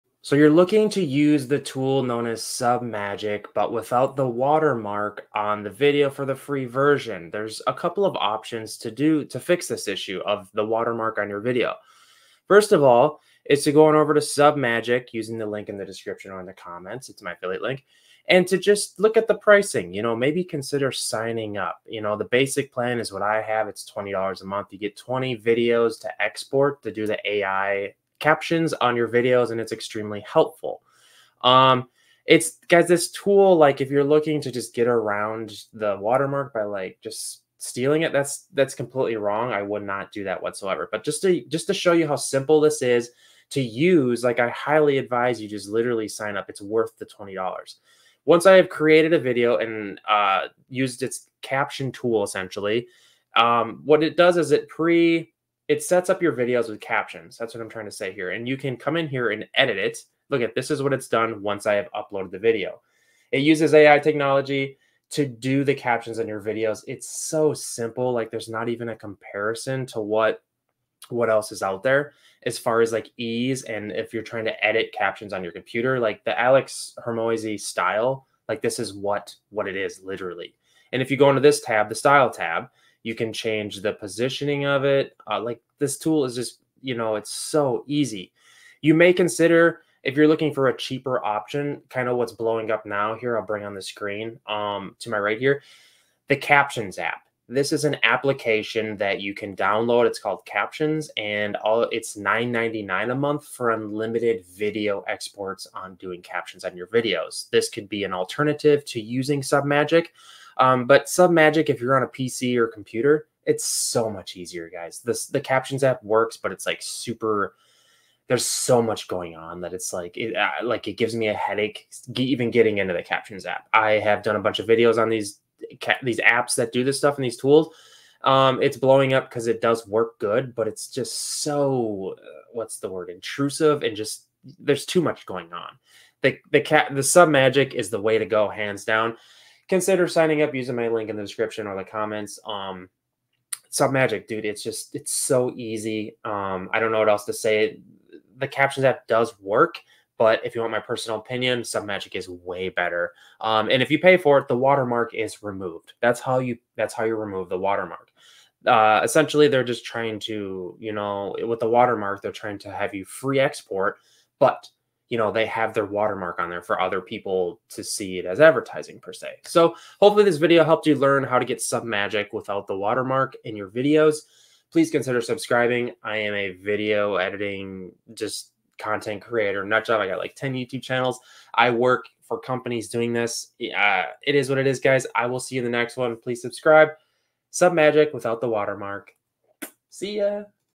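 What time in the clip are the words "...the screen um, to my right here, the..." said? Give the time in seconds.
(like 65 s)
93 s.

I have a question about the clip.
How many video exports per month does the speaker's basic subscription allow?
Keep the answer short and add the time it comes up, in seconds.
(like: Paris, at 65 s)
20, at 24 s.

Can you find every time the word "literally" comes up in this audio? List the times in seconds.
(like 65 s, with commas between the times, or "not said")
45 s, 80 s.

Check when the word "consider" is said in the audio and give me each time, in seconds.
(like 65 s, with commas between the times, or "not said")
20 s, 89 s, 139 s, 174 s.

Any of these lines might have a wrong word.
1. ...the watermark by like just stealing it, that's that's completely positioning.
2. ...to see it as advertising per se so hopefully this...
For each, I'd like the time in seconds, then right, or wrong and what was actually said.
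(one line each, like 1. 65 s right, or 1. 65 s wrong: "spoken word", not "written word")
1. 35 s wrong: "wrong", not "positioning"
2. 167 s right.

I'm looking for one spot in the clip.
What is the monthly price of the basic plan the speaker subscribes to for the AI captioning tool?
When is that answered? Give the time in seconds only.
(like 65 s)
23 s.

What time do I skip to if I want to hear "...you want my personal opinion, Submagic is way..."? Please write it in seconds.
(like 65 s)
150 s.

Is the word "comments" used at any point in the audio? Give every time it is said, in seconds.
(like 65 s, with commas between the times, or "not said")
16 s, 141 s.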